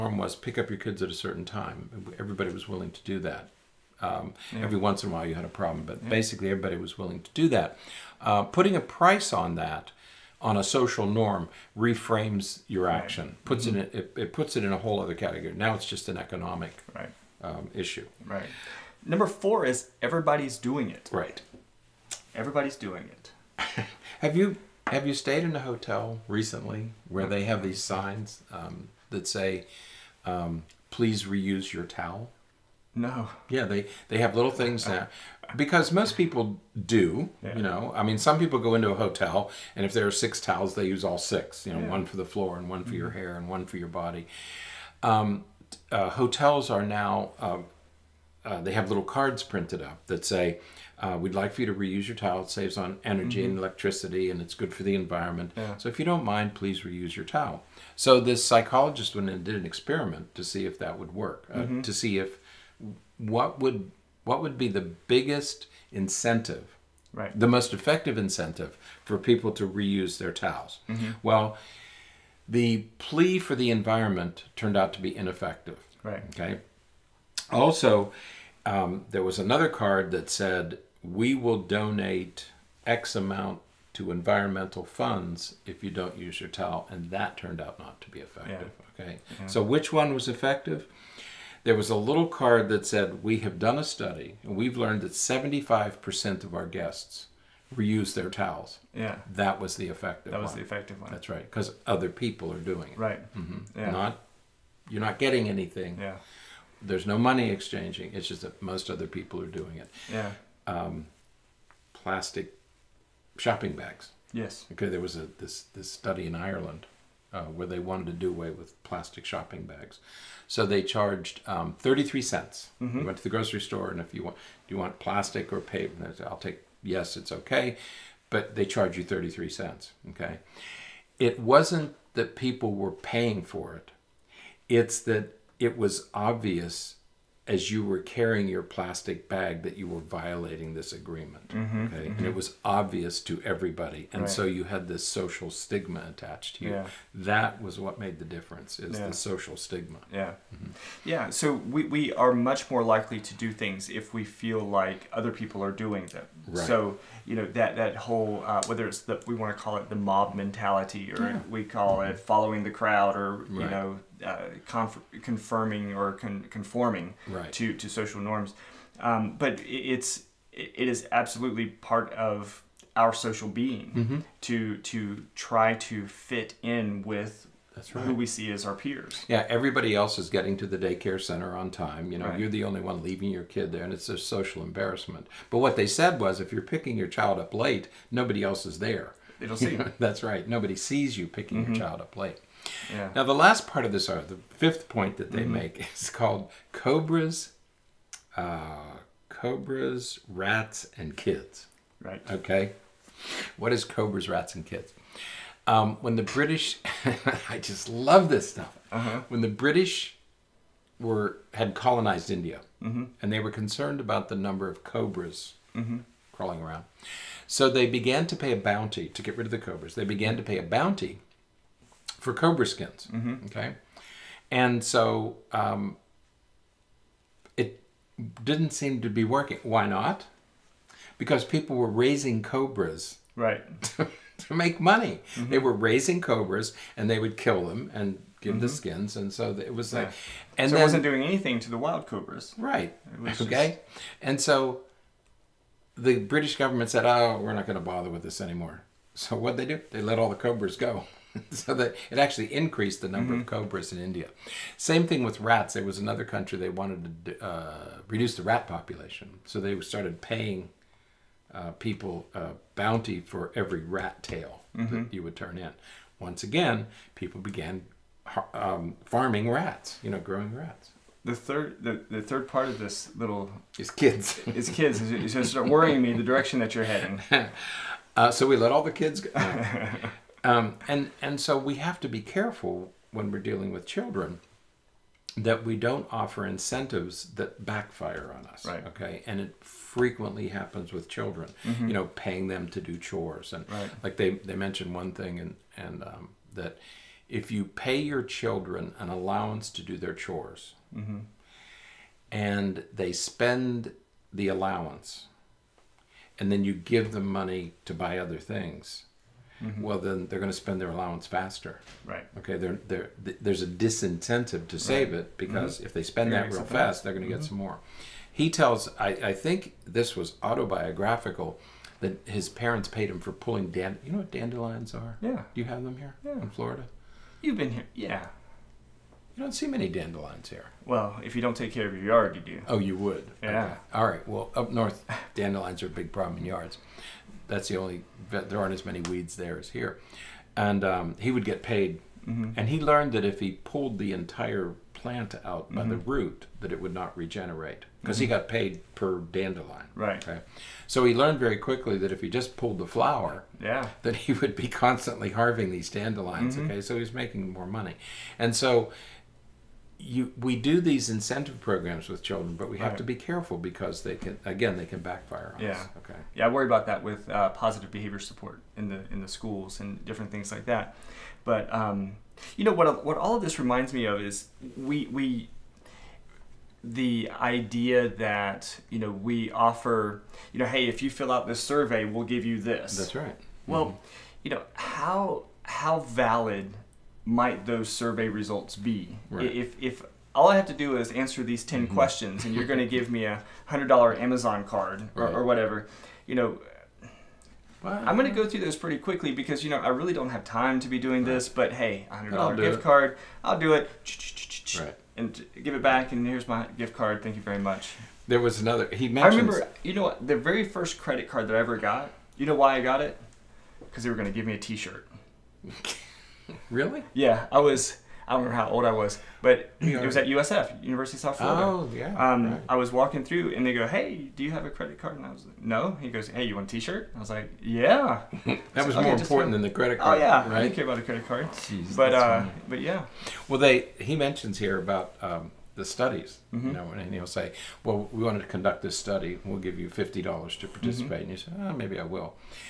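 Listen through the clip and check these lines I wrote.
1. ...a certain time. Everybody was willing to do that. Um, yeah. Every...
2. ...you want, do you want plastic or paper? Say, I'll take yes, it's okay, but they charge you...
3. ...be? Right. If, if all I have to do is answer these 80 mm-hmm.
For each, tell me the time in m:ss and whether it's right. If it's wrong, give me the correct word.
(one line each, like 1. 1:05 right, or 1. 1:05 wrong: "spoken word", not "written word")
1. 0:01 right
2. 2:04 right
3. 6:28 wrong: "10", not "80".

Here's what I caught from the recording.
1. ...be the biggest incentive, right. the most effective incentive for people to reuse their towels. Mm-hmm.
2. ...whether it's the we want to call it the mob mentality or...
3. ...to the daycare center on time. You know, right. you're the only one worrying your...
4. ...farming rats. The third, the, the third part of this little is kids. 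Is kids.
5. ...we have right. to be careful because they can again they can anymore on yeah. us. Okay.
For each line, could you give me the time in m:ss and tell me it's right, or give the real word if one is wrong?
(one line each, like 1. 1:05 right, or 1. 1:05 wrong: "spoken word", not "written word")
1. 1:04 right
2. 2:38 right
3. 3:00 wrong: "leaving", not "worrying"
4. 4:30 wrong: "growing", not "farming"
5. 6:02 wrong: "backfire", not "anymore".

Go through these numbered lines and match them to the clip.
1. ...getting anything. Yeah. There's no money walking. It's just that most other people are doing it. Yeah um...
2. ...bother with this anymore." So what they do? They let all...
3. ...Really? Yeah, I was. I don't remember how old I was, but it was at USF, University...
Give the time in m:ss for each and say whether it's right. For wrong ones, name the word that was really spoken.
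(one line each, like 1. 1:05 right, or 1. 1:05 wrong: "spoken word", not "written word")
1. 1:45 wrong: "exchanging", not "walking"
2. 4:07 right
3. 6:56 right.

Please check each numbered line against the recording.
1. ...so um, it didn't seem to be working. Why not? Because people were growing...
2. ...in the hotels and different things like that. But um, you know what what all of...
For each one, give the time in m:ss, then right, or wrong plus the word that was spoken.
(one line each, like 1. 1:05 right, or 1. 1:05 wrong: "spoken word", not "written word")
1. 3:44 wrong: "raising", not "growing"
2. 6:09 wrong: "schools", not "hotels".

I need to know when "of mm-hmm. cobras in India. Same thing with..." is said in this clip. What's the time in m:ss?
4:13.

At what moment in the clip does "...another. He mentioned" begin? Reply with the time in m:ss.
6:48.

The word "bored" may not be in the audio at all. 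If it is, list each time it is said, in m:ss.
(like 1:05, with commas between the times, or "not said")
not said.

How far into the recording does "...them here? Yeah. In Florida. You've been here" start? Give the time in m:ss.
5:25.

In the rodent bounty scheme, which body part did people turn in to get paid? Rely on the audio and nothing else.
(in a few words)
Rat tail.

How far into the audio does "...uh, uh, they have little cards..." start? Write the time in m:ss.
0:47.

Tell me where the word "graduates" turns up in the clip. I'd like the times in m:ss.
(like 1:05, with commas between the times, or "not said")
not said.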